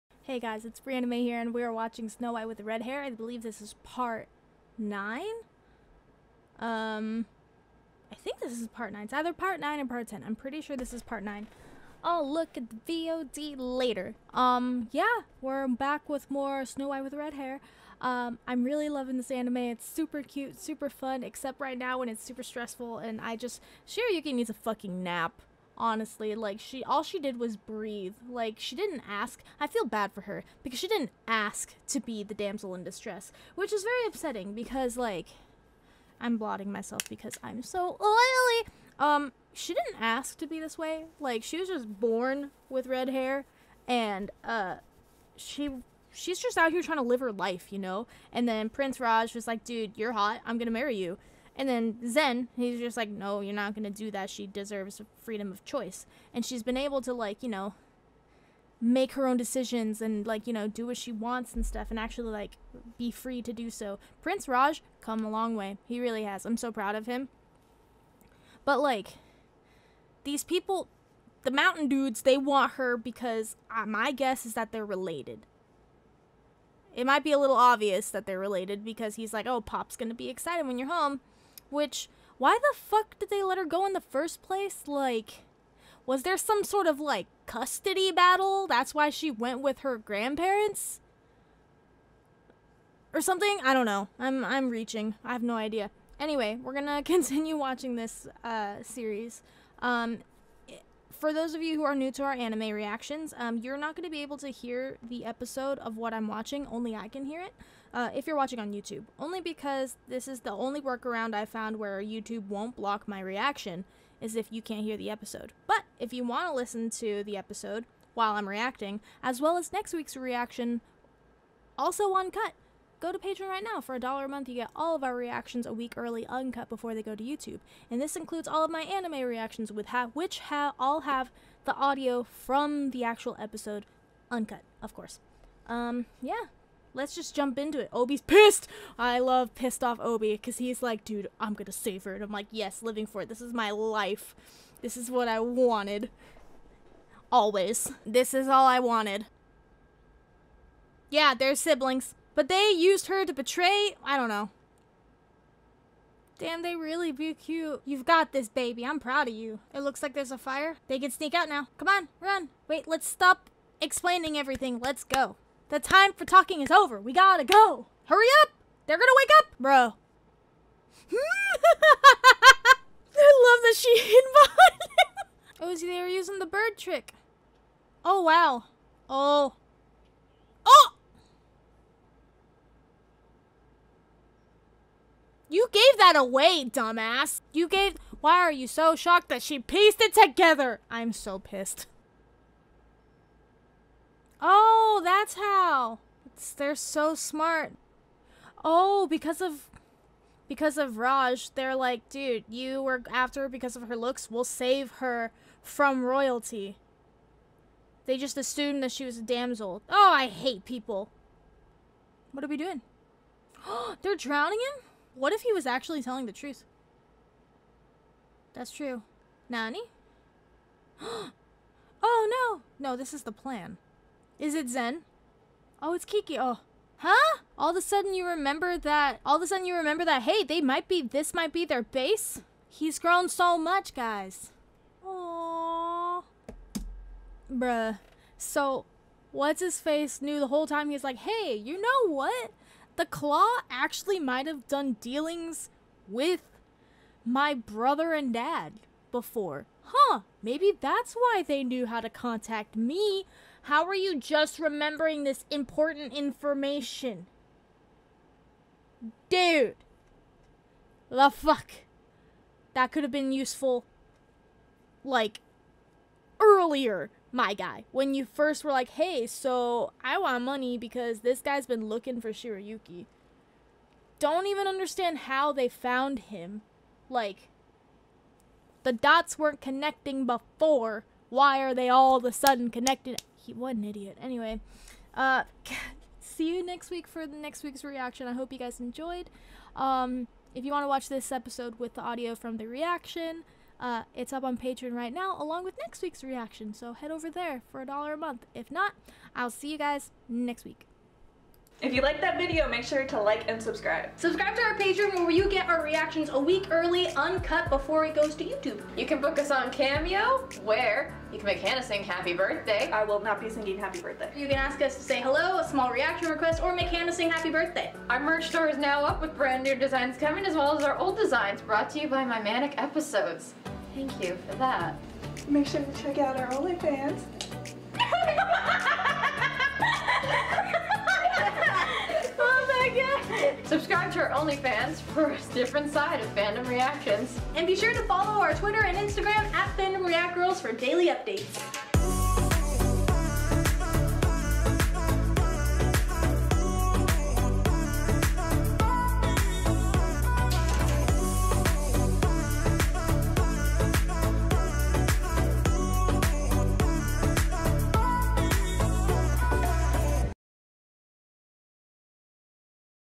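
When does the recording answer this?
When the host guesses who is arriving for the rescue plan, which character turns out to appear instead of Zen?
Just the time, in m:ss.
3:46.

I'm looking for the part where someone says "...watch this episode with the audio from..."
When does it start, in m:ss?
4:50.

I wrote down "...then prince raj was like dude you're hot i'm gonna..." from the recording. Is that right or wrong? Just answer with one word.
right.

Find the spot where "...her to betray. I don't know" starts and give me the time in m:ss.
2:33.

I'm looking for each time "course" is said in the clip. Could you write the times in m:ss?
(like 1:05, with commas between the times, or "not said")
2:14.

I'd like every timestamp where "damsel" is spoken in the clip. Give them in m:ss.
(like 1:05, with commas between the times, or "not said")
0:32, 3:29.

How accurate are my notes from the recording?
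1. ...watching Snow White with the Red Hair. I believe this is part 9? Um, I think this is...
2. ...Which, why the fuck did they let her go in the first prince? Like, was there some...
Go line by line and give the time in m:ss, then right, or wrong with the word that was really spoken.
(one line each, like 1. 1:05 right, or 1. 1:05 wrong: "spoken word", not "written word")
1. 0:01 right
2. 1:21 wrong: "place", not "prince".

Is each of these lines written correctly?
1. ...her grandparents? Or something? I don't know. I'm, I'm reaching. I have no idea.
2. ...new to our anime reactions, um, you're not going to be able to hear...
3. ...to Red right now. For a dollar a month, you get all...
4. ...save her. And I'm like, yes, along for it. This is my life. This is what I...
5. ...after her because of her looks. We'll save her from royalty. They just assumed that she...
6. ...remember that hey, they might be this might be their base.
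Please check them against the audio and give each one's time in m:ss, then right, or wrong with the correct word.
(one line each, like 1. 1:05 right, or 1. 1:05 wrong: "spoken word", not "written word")
1. 1:29 right
2. 1:41 right
3. 2:03 wrong: "Patreon", not "Red"
4. 2:21 wrong: "living", not "along"
5. 3:23 right
6. 3:49 right.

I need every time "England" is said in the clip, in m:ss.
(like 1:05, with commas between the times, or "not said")
not said.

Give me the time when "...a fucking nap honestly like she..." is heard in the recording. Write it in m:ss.
0:24.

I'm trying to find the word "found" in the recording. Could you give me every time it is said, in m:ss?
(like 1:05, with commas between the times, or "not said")
1:51, 4:35.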